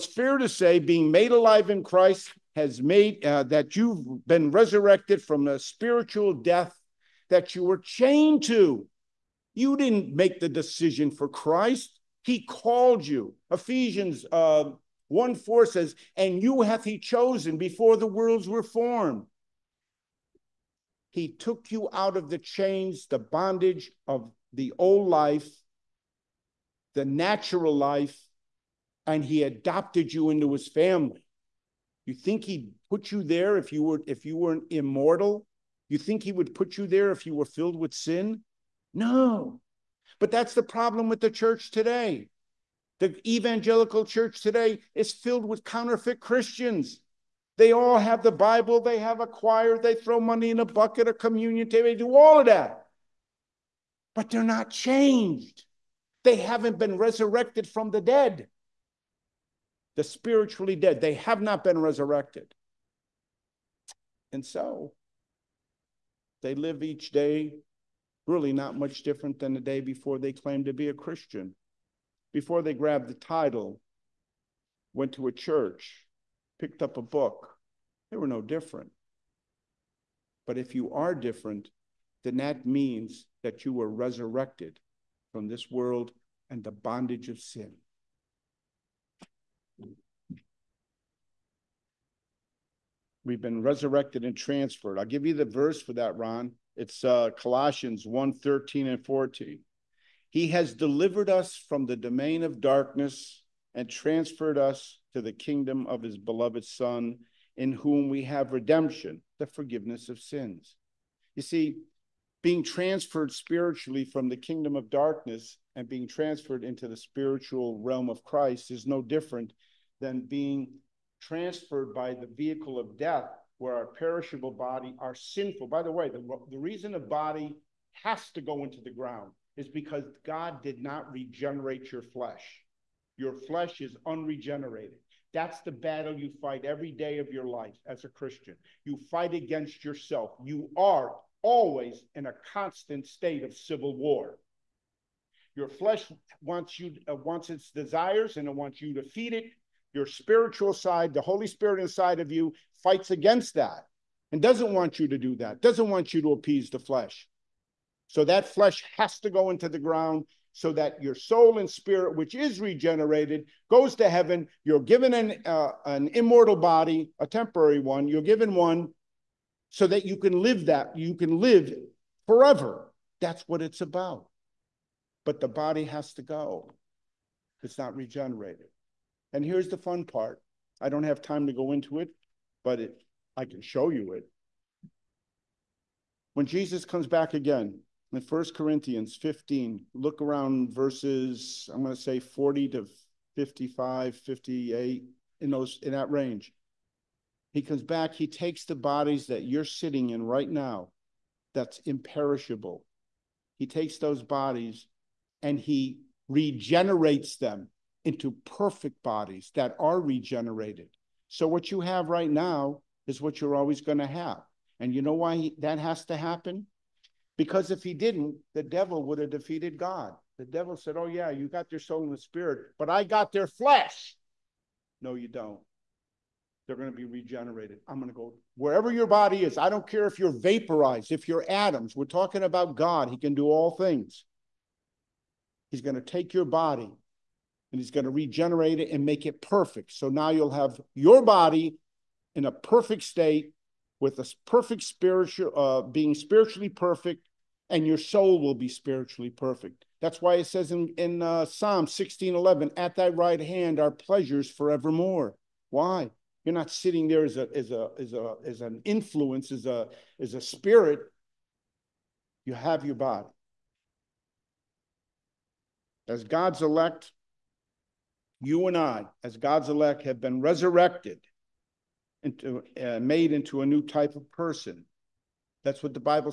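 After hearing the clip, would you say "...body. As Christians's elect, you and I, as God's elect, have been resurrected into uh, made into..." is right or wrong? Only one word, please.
wrong.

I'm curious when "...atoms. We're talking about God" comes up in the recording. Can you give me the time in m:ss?
3:51.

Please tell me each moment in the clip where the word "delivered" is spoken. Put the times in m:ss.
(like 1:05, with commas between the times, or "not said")
1:40.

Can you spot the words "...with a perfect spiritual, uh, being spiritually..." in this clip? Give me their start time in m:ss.
4:04.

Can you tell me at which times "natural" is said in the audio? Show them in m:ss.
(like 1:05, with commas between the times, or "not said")
0:27.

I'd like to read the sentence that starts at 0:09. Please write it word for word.
You didn't make the decision for Christ.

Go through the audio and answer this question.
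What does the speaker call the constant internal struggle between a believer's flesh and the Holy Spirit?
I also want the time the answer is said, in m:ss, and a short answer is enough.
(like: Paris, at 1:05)
civil war, at 2:23.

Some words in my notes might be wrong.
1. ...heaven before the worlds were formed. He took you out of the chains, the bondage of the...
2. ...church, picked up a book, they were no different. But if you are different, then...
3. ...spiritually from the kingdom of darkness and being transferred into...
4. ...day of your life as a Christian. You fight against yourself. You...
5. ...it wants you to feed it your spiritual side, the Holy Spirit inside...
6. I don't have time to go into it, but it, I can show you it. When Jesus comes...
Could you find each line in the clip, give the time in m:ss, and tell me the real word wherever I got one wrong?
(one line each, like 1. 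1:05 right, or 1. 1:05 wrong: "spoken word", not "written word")
1. 0:16 wrong: "chosen", not "heaven"
2. 1:15 right
3. 1:53 right
4. 2:16 right
5. 2:28 right
6. 3:00 right.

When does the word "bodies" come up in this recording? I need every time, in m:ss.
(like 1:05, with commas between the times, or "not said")
3:18, 3:24, 3:29.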